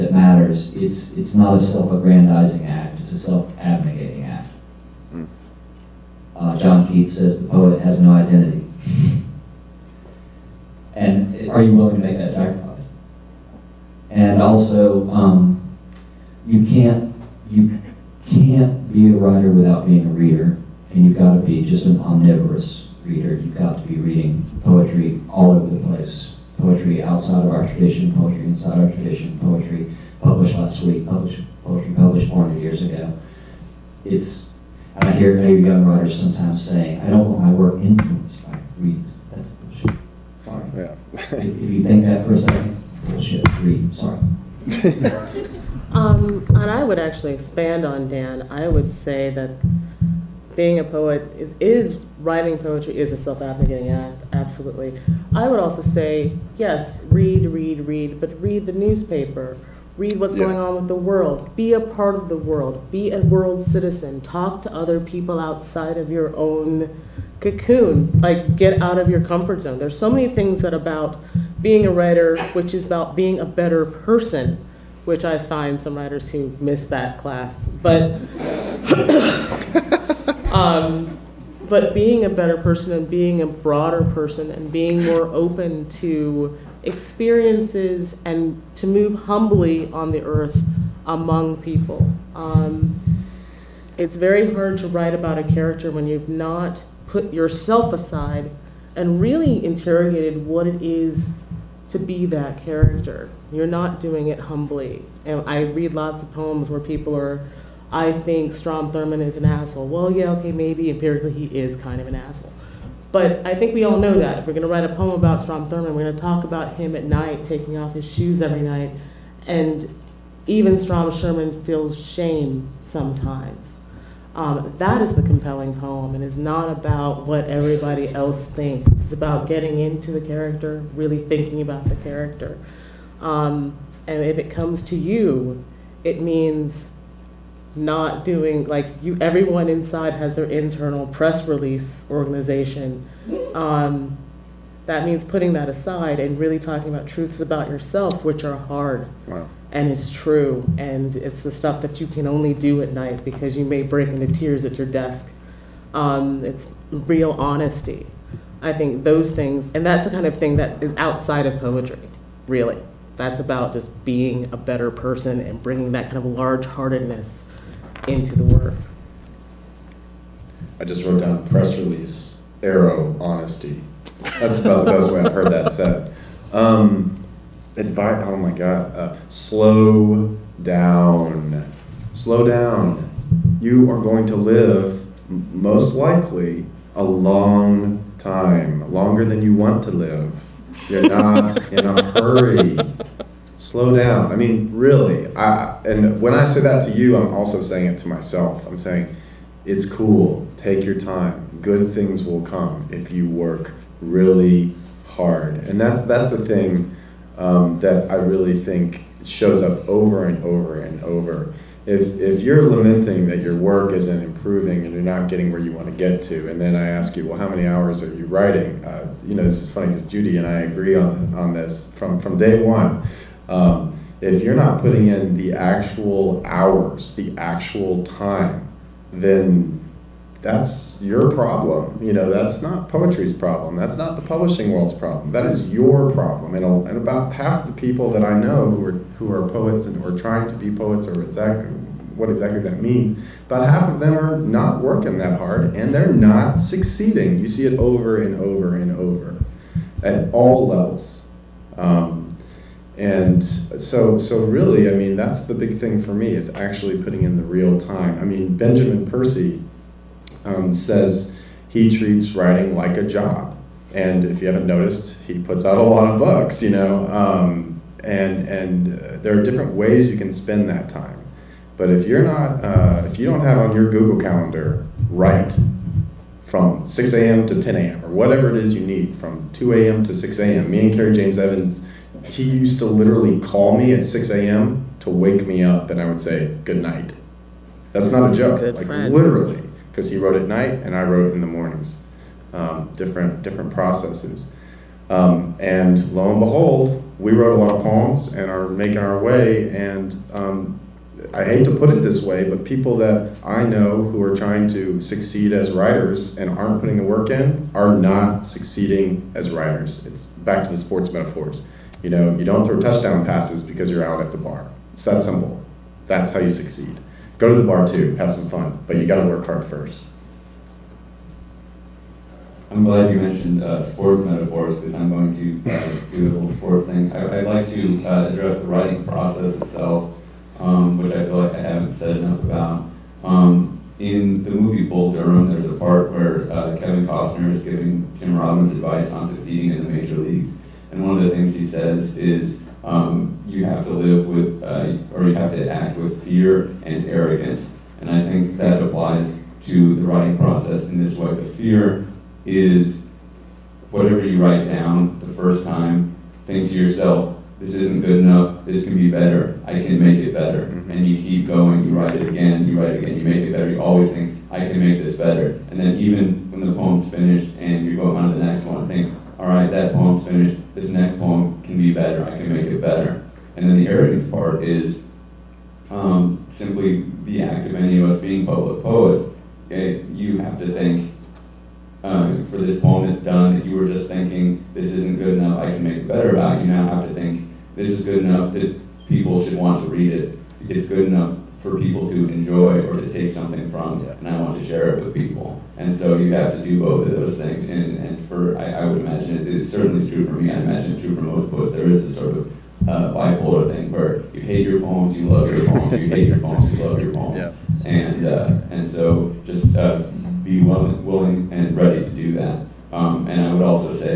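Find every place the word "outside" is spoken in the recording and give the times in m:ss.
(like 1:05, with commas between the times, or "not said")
0:27, 1:05, 2:40.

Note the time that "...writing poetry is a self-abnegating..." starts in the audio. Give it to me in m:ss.
0:52.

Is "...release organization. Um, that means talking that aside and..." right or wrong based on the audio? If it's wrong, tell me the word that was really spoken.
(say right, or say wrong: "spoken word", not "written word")
wrong: "putting", not "talking".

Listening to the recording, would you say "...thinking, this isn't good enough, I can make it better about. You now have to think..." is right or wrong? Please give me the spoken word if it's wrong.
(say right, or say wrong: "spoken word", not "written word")
right.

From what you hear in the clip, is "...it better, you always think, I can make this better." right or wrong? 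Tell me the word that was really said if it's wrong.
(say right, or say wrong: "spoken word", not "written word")
right.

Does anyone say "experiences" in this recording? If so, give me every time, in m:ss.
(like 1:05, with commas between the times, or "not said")
1:26.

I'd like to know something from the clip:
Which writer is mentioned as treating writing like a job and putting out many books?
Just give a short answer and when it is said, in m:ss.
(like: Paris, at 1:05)
Benjamin Percy, at 4:18.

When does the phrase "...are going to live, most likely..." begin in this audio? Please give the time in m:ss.
3:03.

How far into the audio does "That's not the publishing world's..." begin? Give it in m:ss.
3:53.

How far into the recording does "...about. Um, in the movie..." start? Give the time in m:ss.
5:32.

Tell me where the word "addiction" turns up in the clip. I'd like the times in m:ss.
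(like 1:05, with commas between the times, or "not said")
not said.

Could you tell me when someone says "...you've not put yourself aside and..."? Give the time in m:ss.
1:36.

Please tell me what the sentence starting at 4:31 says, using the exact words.
But if you're not, uh, if you don't have on your Google Calendar, write from 6 a.m.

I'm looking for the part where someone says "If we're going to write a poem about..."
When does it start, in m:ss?
1:54.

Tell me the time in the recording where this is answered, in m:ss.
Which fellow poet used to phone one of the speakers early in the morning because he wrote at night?
4:40.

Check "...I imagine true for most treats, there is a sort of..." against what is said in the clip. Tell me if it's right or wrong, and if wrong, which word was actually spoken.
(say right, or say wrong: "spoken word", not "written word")
wrong: "poets", not "treats".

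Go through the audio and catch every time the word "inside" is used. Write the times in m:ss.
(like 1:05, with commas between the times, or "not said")
0:28, 2:19.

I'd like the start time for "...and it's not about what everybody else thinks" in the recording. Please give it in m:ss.
2:06.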